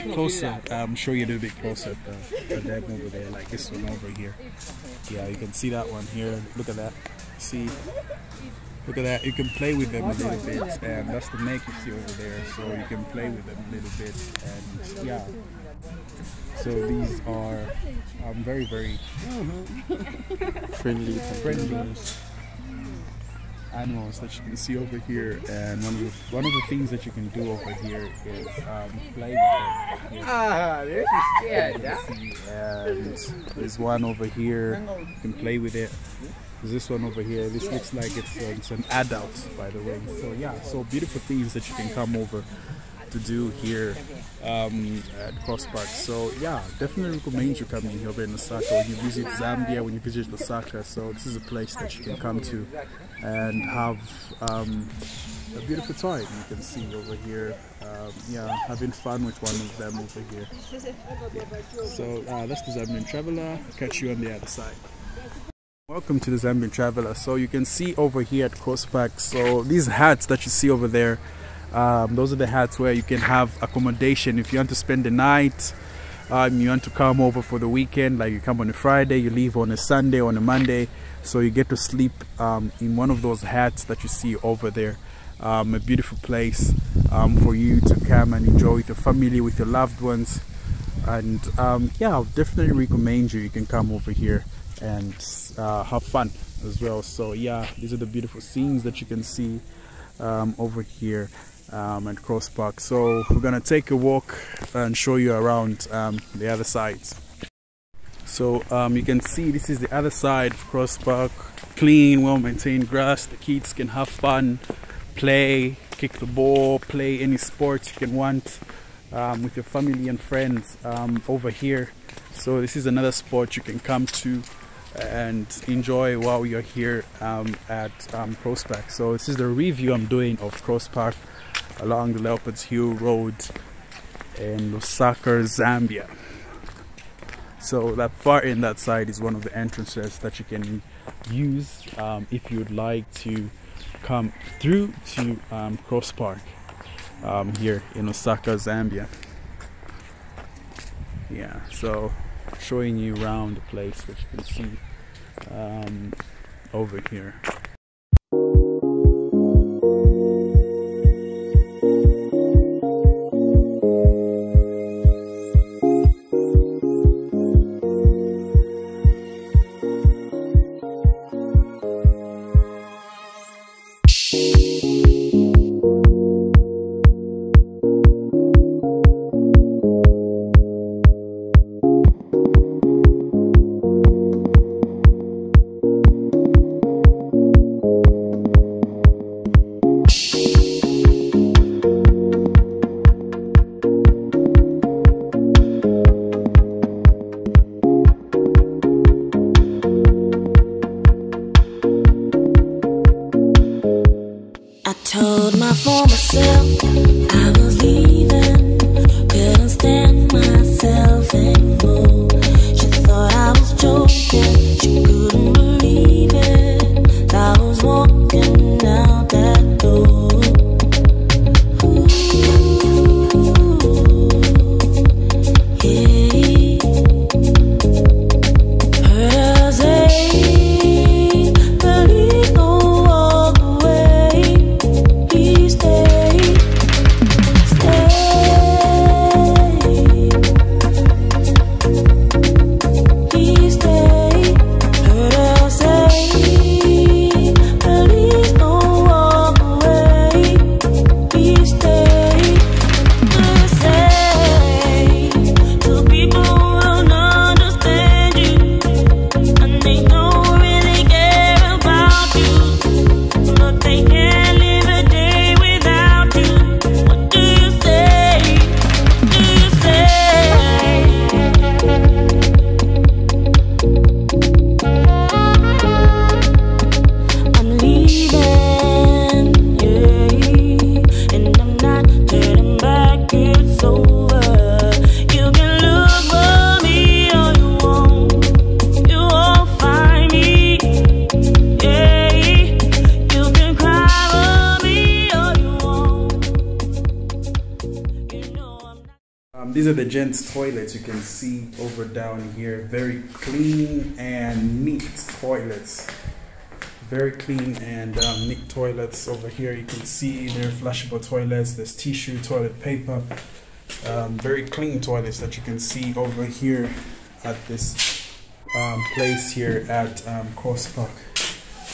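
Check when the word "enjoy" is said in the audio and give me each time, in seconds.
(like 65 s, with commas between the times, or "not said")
88 s, 125 s.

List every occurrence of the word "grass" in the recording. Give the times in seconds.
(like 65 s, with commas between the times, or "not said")
112 s.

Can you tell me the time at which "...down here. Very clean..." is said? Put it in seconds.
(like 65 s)
302 s.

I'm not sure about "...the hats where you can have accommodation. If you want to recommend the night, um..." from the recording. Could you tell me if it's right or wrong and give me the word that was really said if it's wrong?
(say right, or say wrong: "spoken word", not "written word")
wrong: "spend", not "recommend".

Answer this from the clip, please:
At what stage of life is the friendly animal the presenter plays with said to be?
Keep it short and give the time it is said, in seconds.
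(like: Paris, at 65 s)
Adult, at 38 s.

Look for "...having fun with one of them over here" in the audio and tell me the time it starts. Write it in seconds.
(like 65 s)
58 s.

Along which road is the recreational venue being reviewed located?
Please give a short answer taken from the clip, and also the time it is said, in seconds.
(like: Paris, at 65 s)
Leopards Hill Road, at 132 s.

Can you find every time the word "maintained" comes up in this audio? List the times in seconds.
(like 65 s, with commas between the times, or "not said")
112 s.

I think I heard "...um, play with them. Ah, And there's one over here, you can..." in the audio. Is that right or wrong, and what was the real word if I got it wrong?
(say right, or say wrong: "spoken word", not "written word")
right.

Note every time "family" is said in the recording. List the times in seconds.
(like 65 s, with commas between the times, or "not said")
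88 s, 119 s.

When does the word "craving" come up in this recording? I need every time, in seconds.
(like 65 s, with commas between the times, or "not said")
not said.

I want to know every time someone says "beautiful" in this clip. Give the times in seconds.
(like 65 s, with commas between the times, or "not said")
40 s, 55 s, 85 s, 98 s.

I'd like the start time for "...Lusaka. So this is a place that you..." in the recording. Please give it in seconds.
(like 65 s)
50 s.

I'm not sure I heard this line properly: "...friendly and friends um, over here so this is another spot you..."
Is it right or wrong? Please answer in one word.
wrong.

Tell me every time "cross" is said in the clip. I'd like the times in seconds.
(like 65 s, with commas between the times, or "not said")
45 s, 68 s, 102 s, 110 s, 130 s, 145 s, 320 s.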